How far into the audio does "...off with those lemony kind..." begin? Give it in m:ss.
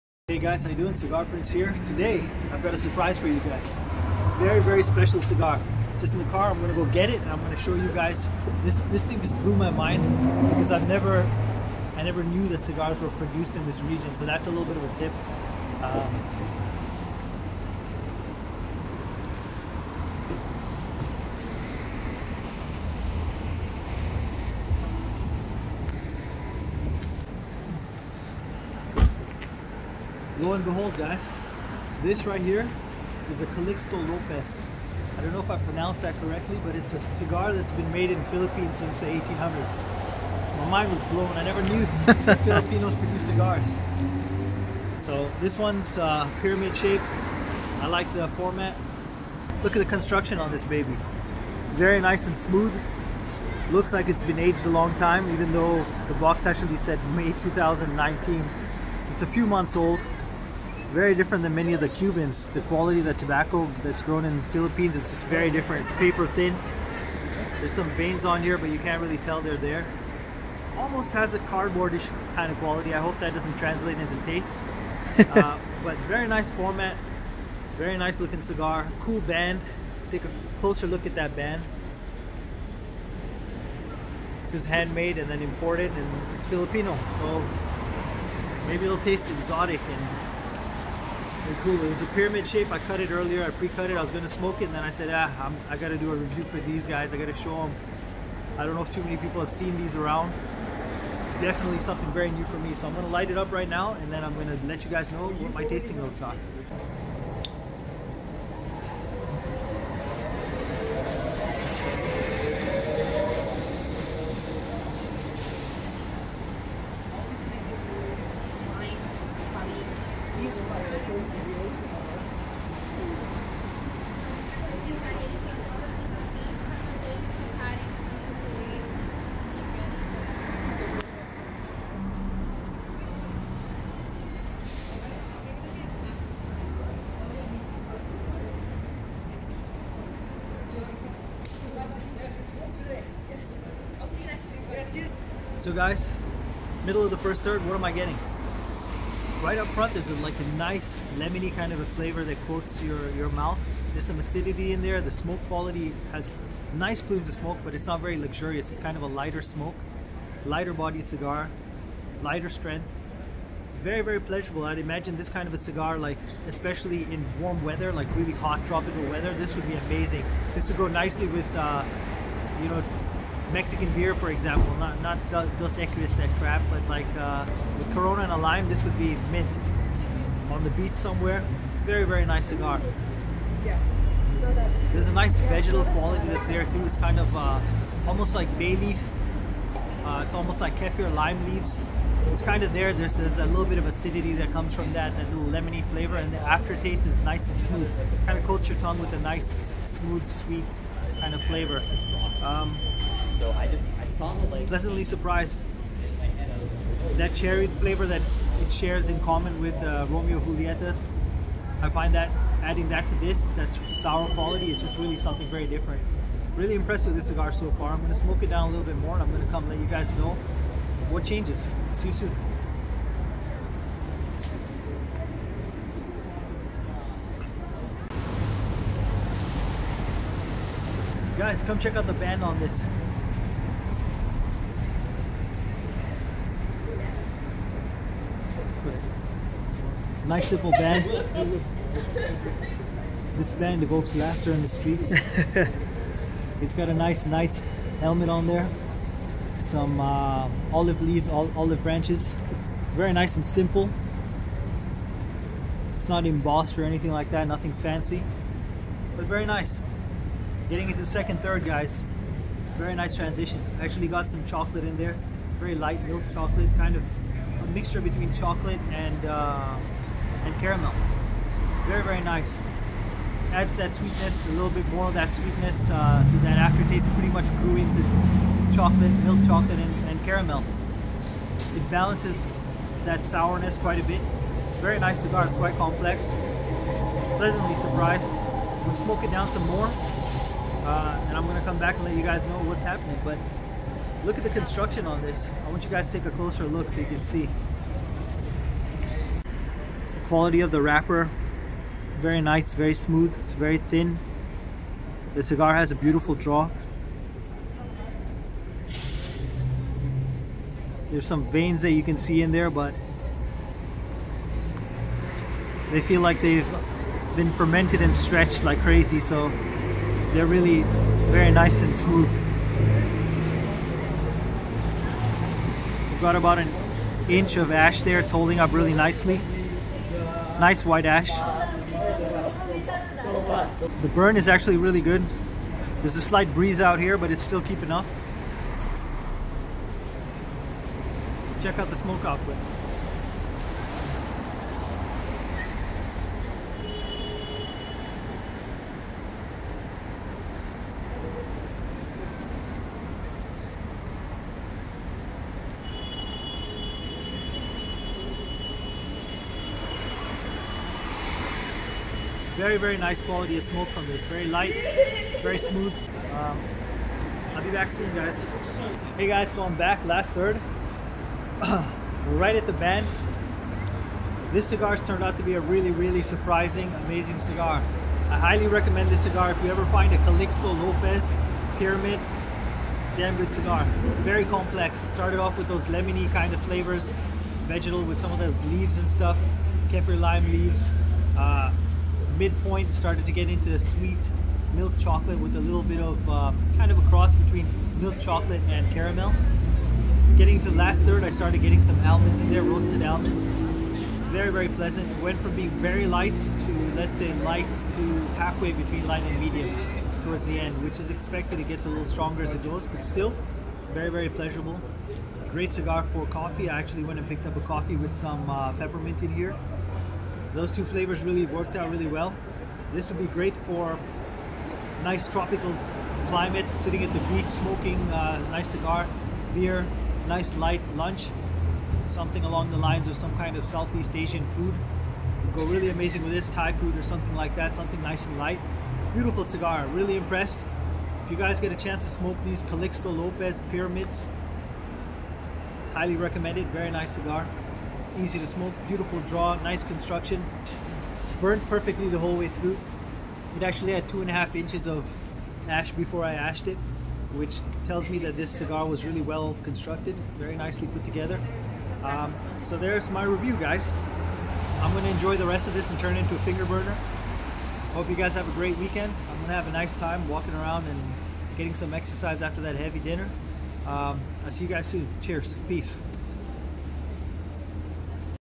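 6:25.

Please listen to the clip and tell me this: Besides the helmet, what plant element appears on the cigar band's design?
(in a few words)
Olive branches.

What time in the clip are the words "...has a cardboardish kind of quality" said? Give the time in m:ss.
1:11.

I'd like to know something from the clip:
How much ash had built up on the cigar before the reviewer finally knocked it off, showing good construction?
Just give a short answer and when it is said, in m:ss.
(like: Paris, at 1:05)
2.5 inches, at 7:34.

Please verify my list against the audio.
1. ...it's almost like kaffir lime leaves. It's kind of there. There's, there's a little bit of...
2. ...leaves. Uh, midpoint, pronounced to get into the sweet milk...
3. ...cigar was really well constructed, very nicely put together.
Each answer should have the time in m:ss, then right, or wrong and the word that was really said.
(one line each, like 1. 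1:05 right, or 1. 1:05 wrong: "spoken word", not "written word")
1. 3:10 right
2. 6:30 wrong: "started", not "pronounced"
3. 7:38 right.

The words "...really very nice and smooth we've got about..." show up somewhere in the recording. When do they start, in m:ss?
5:20.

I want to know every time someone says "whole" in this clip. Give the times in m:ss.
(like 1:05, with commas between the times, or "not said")
7:32.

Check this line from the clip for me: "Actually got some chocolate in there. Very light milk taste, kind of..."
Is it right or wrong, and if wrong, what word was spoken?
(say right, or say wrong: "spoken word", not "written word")
wrong: "chocolate", not "taste".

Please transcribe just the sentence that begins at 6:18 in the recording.
I highly recommend this cigar if you ever find a Calixto Lopez Pyramid.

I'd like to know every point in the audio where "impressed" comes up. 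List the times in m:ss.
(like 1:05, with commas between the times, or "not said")
3:36, 7:20.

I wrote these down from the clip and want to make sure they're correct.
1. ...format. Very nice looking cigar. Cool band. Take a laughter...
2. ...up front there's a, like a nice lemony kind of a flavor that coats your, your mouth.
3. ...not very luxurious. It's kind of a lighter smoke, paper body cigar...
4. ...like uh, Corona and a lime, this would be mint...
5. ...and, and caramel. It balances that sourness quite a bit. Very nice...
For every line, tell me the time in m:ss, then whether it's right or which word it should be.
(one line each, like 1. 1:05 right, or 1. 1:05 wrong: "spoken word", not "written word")
1. 1:16 wrong: "closer", not "laughter"
2. 2:29 right
3. 2:37 wrong: "lighter", not "paper"
4. 2:56 right
5. 4:39 right.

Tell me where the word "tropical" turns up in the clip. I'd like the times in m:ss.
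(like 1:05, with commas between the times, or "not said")
2:48, 7:05.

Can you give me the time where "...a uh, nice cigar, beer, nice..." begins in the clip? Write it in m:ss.
7:08.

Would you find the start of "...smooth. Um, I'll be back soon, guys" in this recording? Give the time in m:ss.
6:05.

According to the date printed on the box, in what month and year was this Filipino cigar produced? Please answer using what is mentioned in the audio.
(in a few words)
May 2019.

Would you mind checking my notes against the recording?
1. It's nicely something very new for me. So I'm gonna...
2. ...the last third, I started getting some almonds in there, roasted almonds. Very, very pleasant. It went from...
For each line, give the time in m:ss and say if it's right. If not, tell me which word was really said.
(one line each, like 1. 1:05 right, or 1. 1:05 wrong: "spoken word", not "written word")
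1. 1:40 wrong: "definitely", not "nicely"
2. 6:40 right.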